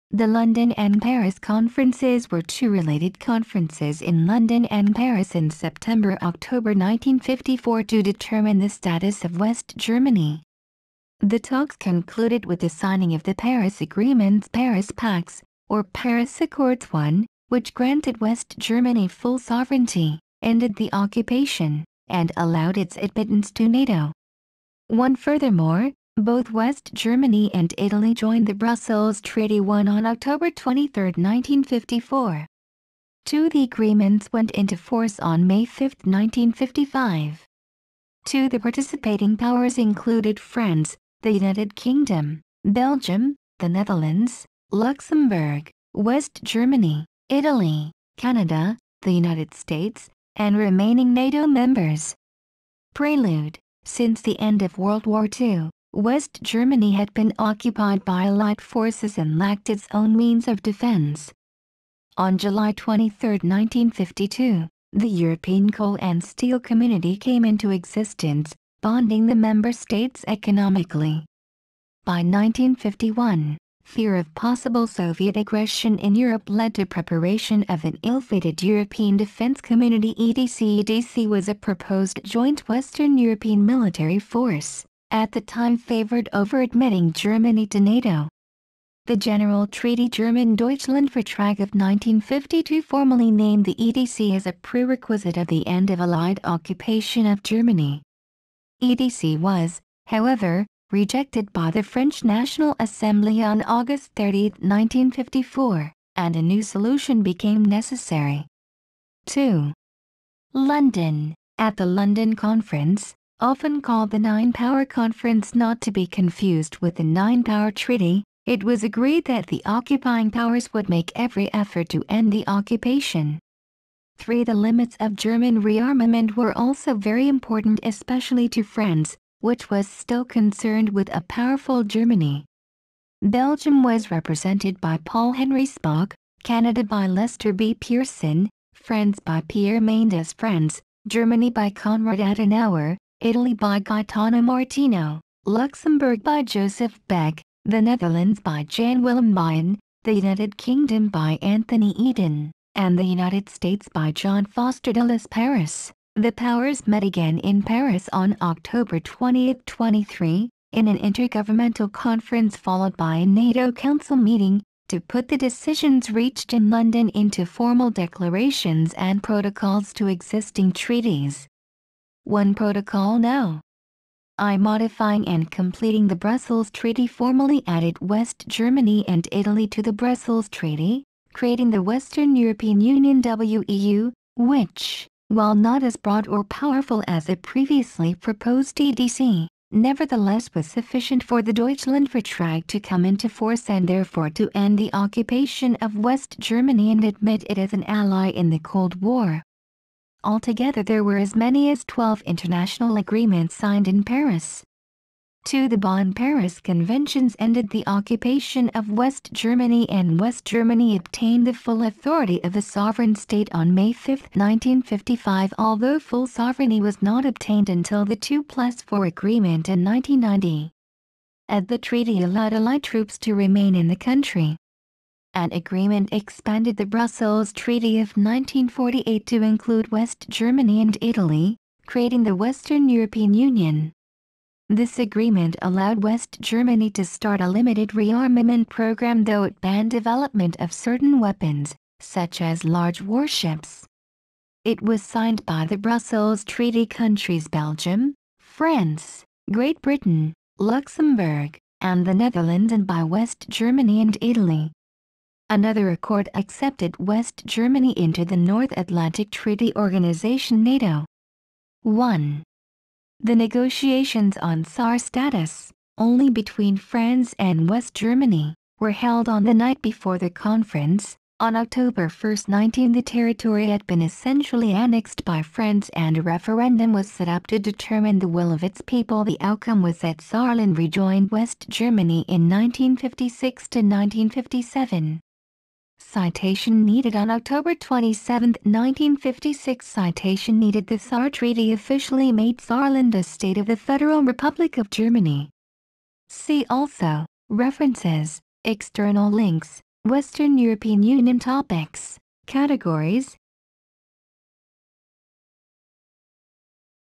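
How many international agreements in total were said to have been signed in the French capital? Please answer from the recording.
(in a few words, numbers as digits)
12.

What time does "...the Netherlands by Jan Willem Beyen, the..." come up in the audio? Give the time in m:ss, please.
2:27.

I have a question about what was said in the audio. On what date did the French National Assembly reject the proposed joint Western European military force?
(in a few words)
August 30, 1954.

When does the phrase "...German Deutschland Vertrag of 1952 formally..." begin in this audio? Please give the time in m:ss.
1:30.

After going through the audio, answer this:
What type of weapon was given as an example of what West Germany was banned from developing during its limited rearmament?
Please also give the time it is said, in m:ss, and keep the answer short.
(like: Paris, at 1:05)
large warships, at 4:02.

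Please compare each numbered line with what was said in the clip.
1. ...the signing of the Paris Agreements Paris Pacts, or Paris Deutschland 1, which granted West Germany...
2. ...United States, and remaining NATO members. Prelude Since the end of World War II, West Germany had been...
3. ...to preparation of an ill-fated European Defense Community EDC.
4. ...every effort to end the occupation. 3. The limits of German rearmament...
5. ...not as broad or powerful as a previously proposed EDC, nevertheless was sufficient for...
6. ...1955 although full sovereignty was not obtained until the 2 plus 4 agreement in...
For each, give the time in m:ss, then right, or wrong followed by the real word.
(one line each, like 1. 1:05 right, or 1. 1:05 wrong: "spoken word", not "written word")
1. 0:12 wrong: "Accords", not "Deutschland"
2. 0:49 right
3. 1:16 right
4. 2:01 right
5. 3:05 right
6. 3:34 right.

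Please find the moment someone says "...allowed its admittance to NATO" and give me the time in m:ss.
0:22.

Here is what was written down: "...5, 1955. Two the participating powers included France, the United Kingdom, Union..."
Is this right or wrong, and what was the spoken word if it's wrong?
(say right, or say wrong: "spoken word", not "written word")
wrong: "Belgium", not "Union".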